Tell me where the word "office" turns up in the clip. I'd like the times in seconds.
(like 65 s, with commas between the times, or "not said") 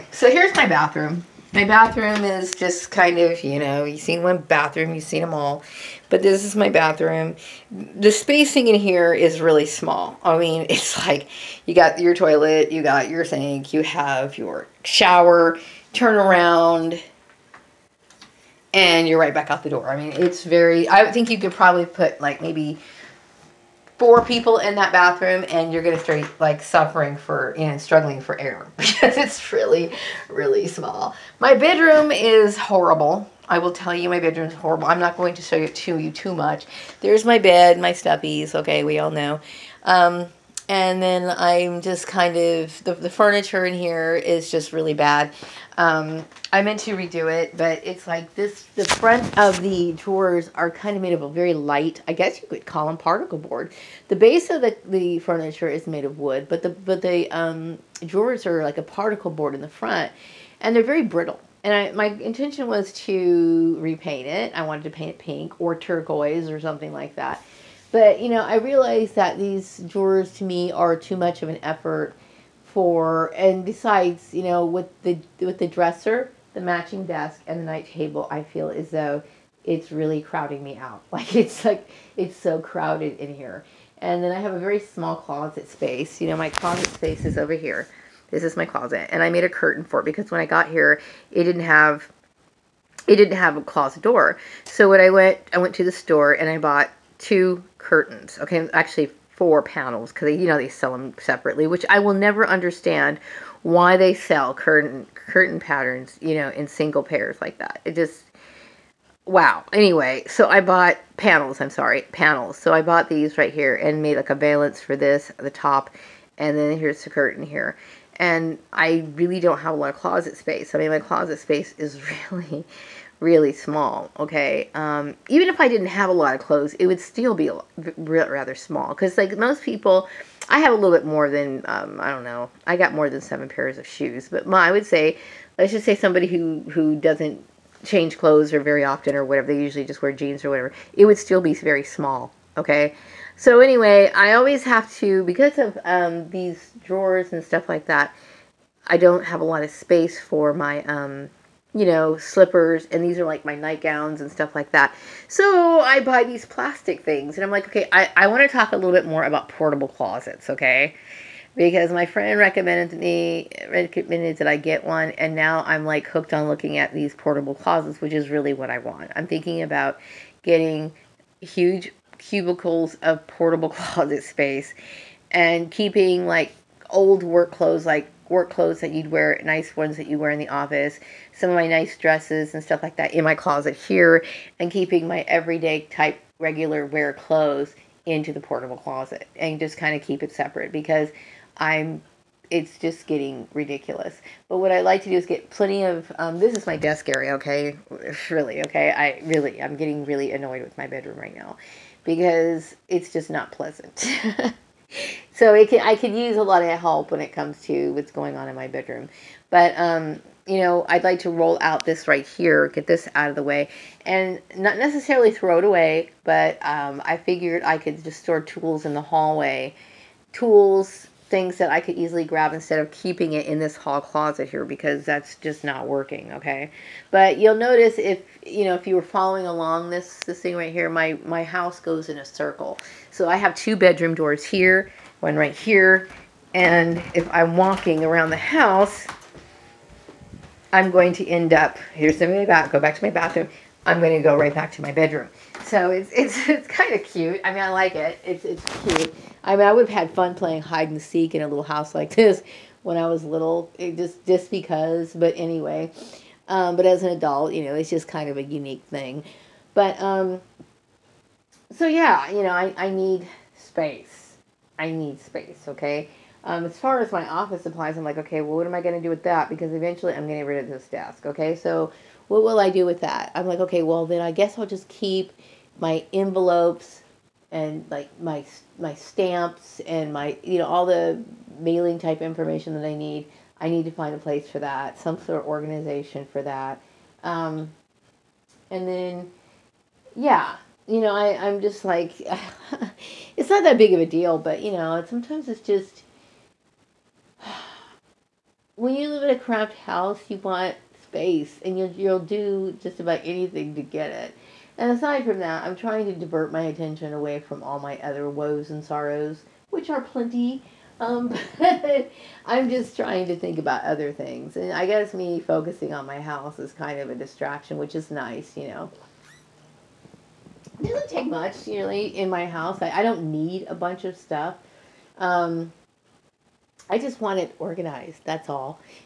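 180 s, 267 s.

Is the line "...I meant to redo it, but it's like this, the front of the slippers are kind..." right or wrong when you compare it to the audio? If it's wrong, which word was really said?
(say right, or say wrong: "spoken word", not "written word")
wrong: "drawers", not "slippers".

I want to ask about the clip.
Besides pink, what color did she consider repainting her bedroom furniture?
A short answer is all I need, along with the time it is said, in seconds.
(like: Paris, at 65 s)
turquoise, at 65 s.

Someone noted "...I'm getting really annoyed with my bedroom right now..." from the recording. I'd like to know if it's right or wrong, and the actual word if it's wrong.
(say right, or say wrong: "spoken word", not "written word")
right.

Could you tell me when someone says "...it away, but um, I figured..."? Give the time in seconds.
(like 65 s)
215 s.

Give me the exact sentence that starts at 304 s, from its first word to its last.
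And aside from that, I'm trying to divert my attention away from all my other woes and sorrows, which are plenty.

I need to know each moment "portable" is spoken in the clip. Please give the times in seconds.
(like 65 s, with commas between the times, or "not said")
159 s, 167 s, 173 s, 188 s.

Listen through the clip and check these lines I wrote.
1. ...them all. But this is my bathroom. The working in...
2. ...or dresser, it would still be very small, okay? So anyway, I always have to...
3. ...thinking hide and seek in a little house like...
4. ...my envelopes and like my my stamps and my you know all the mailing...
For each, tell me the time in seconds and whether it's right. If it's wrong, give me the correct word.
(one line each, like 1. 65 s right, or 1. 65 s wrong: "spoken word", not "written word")
1. 5 s wrong: "spacing", not "working"
2. 140 s wrong: "whatever", not "dresser"
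3. 250 s wrong: "playing", not "thinking"
4. 275 s right.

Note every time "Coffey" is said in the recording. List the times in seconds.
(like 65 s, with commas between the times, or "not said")
not said.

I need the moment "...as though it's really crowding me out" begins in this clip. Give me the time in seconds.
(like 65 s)
78 s.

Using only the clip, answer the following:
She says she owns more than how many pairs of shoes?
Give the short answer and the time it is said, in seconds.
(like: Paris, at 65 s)
7, at 133 s.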